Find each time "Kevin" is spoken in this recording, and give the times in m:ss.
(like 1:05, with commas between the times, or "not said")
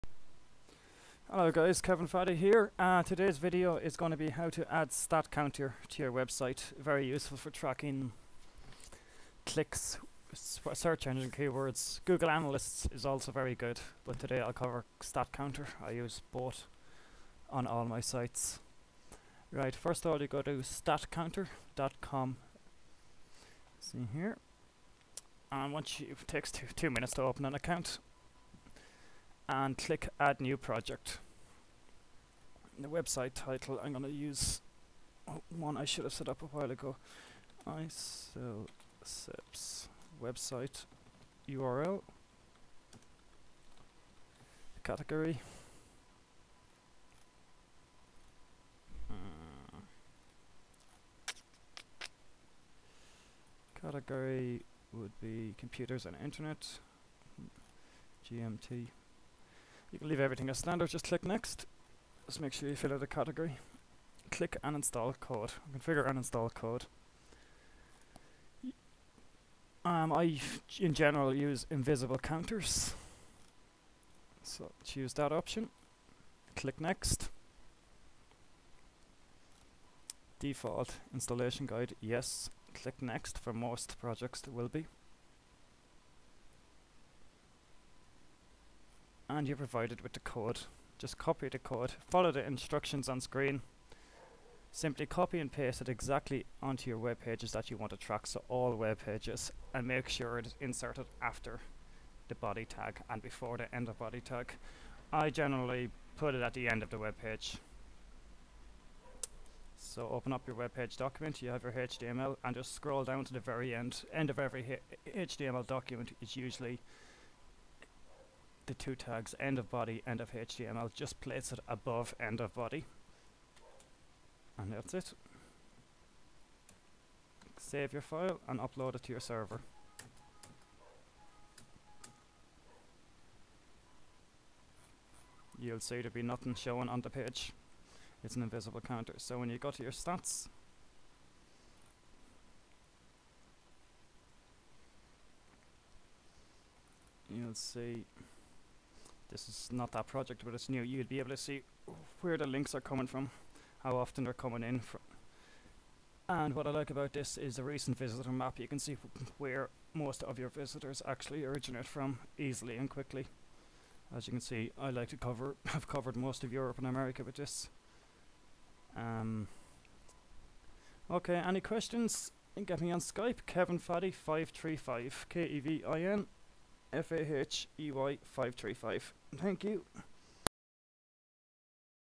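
0:01, 2:53.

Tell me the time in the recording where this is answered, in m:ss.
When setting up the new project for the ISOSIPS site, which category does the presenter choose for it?
0:55.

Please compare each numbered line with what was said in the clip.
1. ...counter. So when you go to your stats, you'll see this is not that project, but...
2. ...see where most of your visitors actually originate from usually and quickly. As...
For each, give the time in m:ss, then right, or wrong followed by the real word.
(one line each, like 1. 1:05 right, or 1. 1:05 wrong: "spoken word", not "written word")
1. 2:18 right
2. 2:38 wrong: "easily", not "usually".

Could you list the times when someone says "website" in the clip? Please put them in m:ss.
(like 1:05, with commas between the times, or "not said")
0:06, 0:32, 0:40.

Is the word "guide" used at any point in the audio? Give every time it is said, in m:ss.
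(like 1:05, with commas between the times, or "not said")
1:21.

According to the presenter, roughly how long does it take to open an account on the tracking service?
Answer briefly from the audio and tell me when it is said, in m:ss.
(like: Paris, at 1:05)
2 minutes, at 0:26.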